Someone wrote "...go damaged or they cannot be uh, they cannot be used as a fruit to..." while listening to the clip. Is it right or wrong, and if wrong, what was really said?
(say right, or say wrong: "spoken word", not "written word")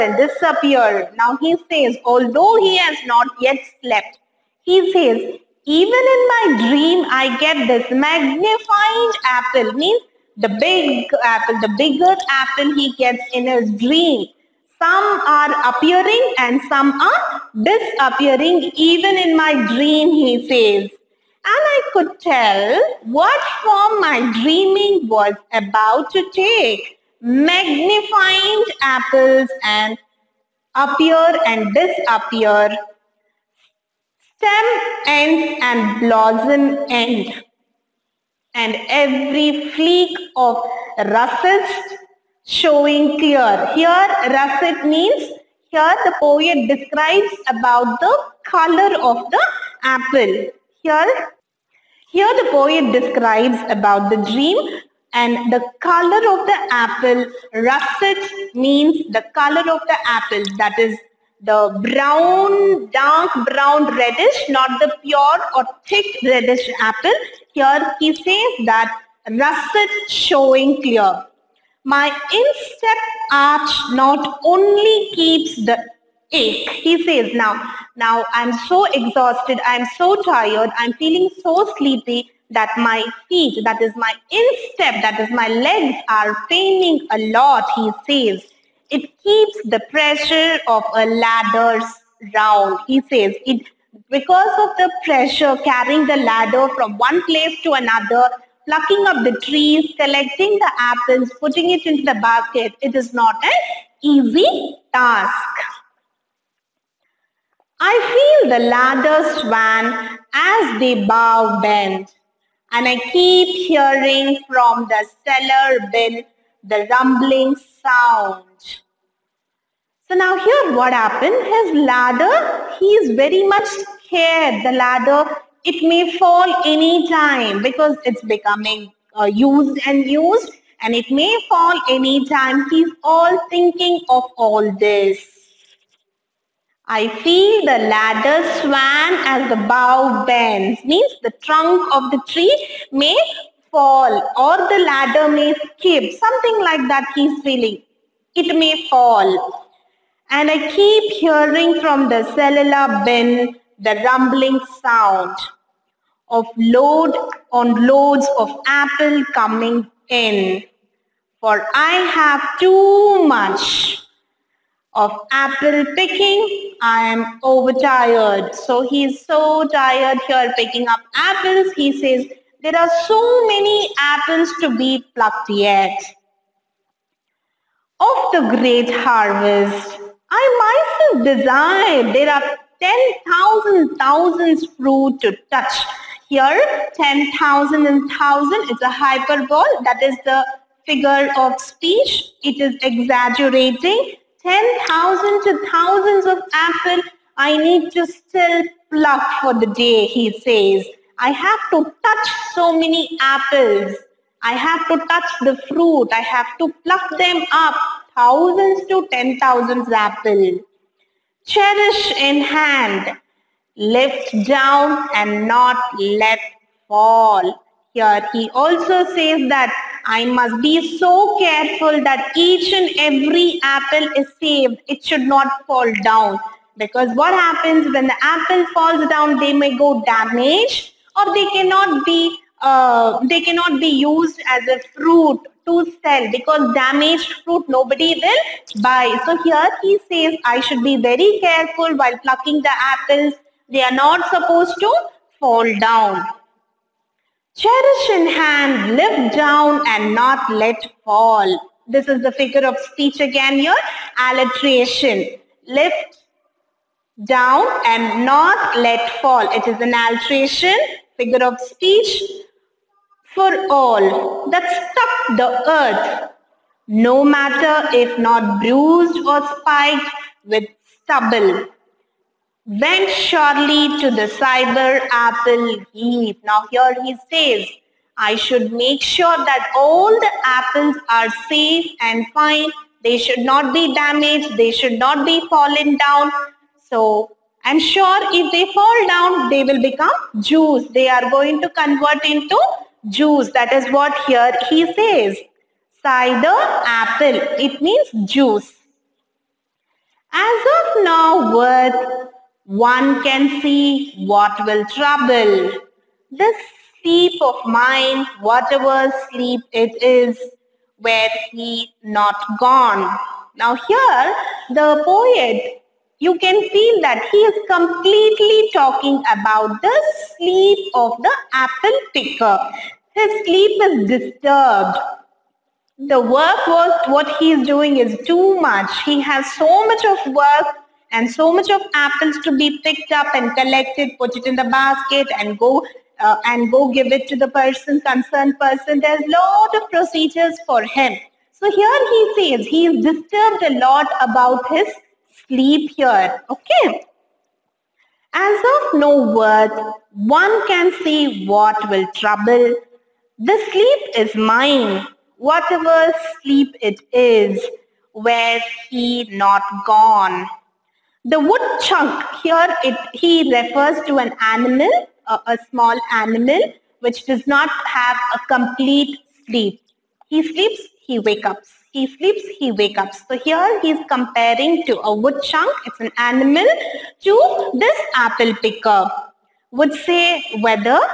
right.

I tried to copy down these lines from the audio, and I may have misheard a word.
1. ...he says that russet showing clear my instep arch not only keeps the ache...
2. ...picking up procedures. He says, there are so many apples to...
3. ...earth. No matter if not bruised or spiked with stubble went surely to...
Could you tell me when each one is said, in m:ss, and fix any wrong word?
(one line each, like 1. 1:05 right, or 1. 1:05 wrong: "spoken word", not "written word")
1. 1:07 right
2. 2:50 wrong: "apples", not "procedures"
3. 4:25 right.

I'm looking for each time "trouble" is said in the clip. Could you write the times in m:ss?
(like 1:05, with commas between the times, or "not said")
5:04, 5:52.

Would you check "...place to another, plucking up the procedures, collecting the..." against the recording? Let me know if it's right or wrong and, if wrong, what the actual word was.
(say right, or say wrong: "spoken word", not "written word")
wrong: "trees", not "procedures".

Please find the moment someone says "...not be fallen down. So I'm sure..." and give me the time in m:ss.
4:44.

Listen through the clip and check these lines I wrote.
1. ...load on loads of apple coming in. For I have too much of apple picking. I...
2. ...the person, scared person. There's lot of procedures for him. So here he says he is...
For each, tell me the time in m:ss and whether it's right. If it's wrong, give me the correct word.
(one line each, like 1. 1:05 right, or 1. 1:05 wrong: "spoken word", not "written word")
1. 2:36 right
2. 5:37 wrong: "concerned", not "scared".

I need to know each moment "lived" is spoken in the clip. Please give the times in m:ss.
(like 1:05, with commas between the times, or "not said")
not said.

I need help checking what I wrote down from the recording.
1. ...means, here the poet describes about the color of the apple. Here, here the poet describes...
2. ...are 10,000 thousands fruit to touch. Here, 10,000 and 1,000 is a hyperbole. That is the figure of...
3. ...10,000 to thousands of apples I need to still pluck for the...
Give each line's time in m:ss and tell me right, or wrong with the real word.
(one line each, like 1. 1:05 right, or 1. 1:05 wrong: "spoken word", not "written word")
1. 0:44 right
2. 3:02 right
3. 3:14 right.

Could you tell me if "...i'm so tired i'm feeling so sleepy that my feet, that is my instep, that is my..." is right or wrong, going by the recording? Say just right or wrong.
right.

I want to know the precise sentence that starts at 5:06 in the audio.
This sleep of mine, whatever sleep it is, where he not gone.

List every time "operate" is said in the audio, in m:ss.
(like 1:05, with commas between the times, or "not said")
not said.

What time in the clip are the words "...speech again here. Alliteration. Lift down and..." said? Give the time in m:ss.
4:12.